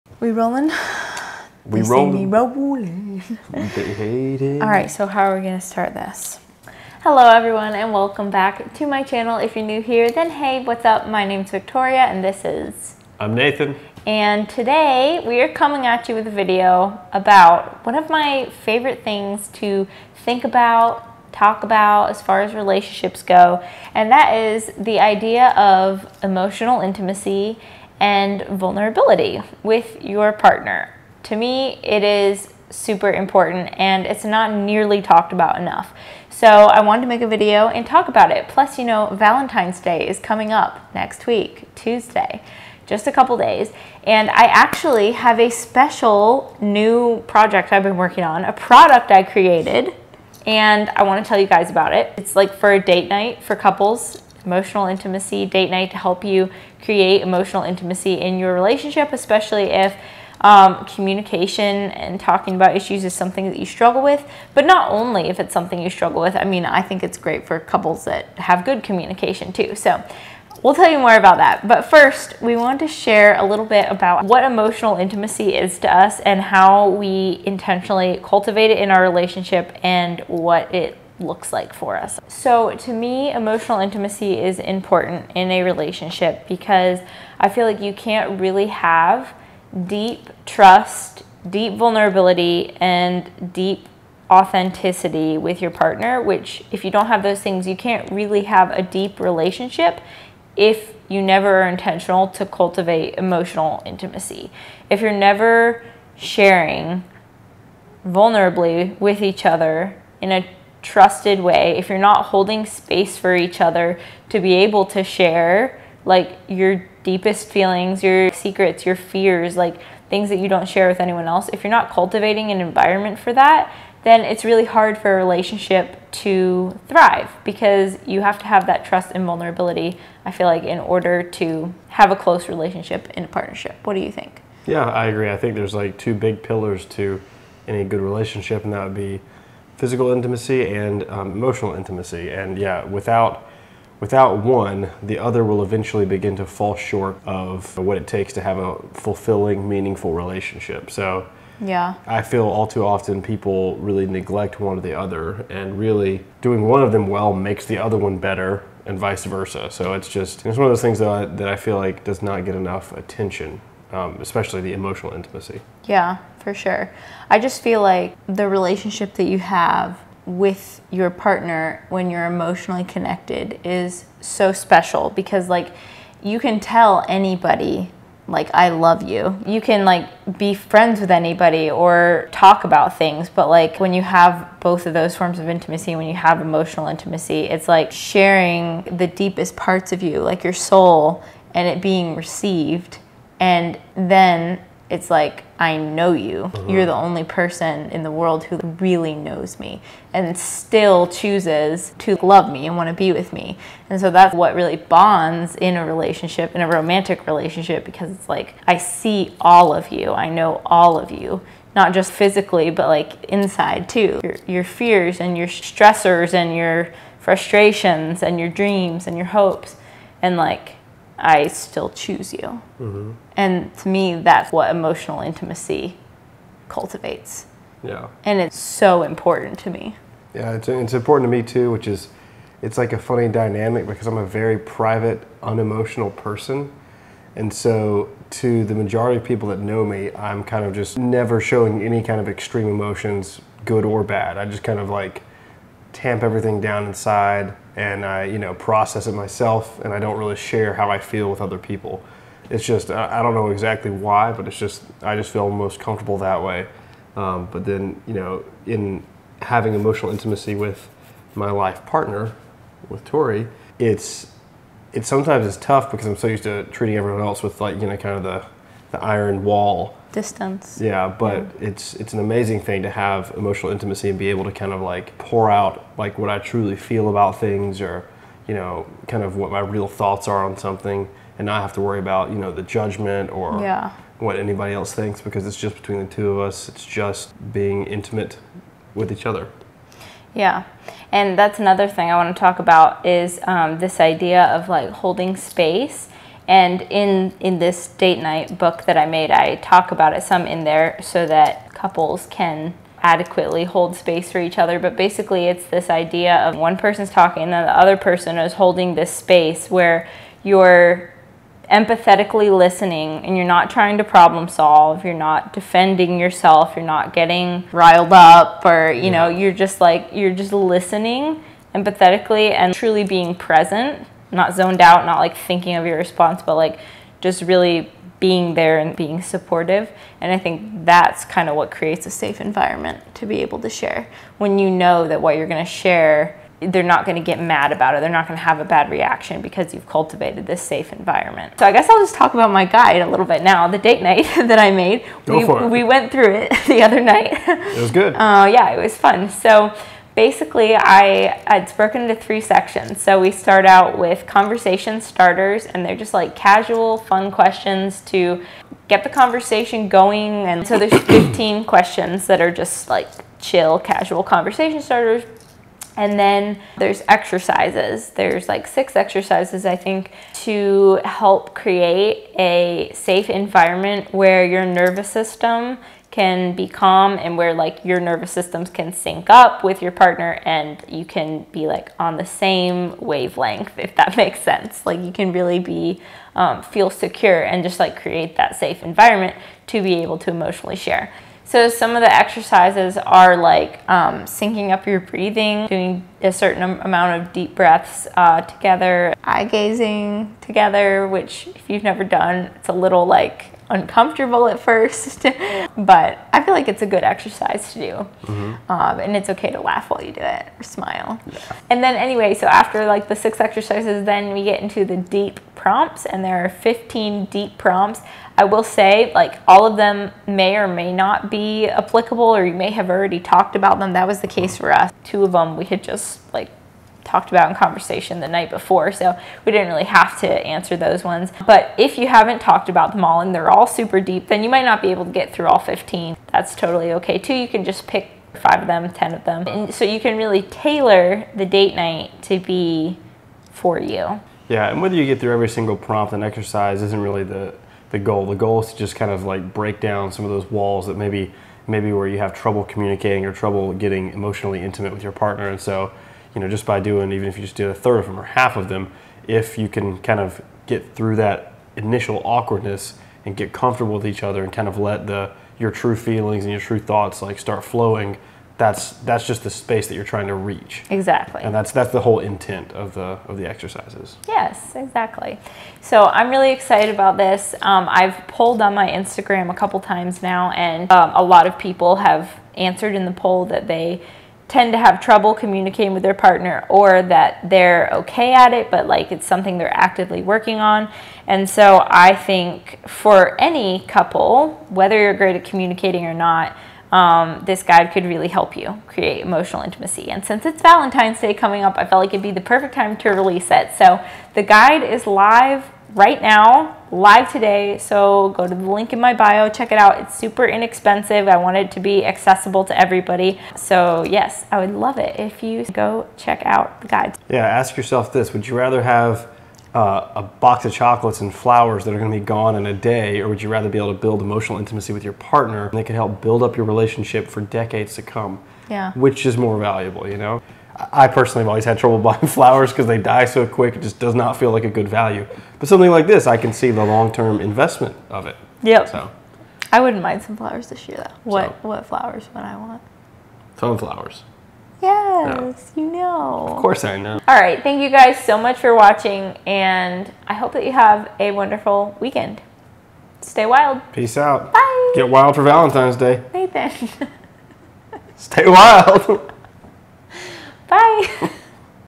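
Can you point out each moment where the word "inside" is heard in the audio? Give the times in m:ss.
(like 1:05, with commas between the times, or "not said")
3:33, 4:06.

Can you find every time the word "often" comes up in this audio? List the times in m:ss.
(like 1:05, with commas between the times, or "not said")
2:32.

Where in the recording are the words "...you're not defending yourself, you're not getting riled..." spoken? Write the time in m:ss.
5:15.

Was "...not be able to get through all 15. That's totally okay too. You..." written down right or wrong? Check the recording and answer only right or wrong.
right.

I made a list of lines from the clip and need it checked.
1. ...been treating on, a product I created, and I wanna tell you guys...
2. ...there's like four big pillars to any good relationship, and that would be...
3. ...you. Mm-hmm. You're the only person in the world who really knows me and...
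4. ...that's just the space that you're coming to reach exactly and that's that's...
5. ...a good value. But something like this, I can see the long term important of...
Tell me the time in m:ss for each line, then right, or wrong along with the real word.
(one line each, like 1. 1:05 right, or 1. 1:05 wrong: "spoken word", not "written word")
1. 0:47 wrong: "working", not "treating"
2. 2:15 wrong: "two", not "four"
3. 3:16 right
4. 7:48 wrong: "trying", not "coming"
5. 8:54 wrong: "investment", not "important".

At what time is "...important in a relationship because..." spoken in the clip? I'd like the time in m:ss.
1:24.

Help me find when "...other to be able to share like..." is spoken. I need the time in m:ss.
1:53.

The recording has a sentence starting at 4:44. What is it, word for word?
what anybody else thinks because it's just between the two of us.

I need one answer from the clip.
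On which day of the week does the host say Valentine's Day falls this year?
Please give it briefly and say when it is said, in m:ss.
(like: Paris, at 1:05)
Tuesday, at 0:41.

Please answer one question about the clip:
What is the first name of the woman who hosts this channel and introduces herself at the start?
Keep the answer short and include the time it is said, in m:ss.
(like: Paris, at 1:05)
Victoria, at 0:11.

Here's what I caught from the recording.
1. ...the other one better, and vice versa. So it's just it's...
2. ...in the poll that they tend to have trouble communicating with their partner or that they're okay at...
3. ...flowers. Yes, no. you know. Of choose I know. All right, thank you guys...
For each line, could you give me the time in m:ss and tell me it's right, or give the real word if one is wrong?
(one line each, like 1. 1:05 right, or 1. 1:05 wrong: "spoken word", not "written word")
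1. 2:37 right
2. 8:02 right
3. 9:03 wrong: "course", not "choose".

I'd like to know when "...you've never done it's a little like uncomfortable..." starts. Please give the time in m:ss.
6:41.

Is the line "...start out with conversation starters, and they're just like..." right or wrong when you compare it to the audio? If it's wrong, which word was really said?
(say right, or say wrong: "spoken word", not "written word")
right.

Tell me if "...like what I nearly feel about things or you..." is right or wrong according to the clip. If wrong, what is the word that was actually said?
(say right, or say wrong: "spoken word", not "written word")
wrong: "truly", not "nearly".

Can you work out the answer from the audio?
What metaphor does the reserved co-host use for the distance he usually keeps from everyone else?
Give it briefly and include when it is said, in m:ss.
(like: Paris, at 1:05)
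iron wall, at 4:29.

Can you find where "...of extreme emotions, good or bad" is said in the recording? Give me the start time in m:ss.
4:02.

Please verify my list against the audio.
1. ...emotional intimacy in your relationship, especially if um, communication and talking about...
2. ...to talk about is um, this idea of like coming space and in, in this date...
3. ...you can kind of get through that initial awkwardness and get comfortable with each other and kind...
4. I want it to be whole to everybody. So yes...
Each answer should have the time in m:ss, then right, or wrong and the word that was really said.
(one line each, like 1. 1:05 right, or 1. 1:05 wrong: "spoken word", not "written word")
1. 0:57 right
2. 4:52 wrong: "holding", not "coming"
3. 7:39 right
4. 8:31 wrong: "accessible", not "whole".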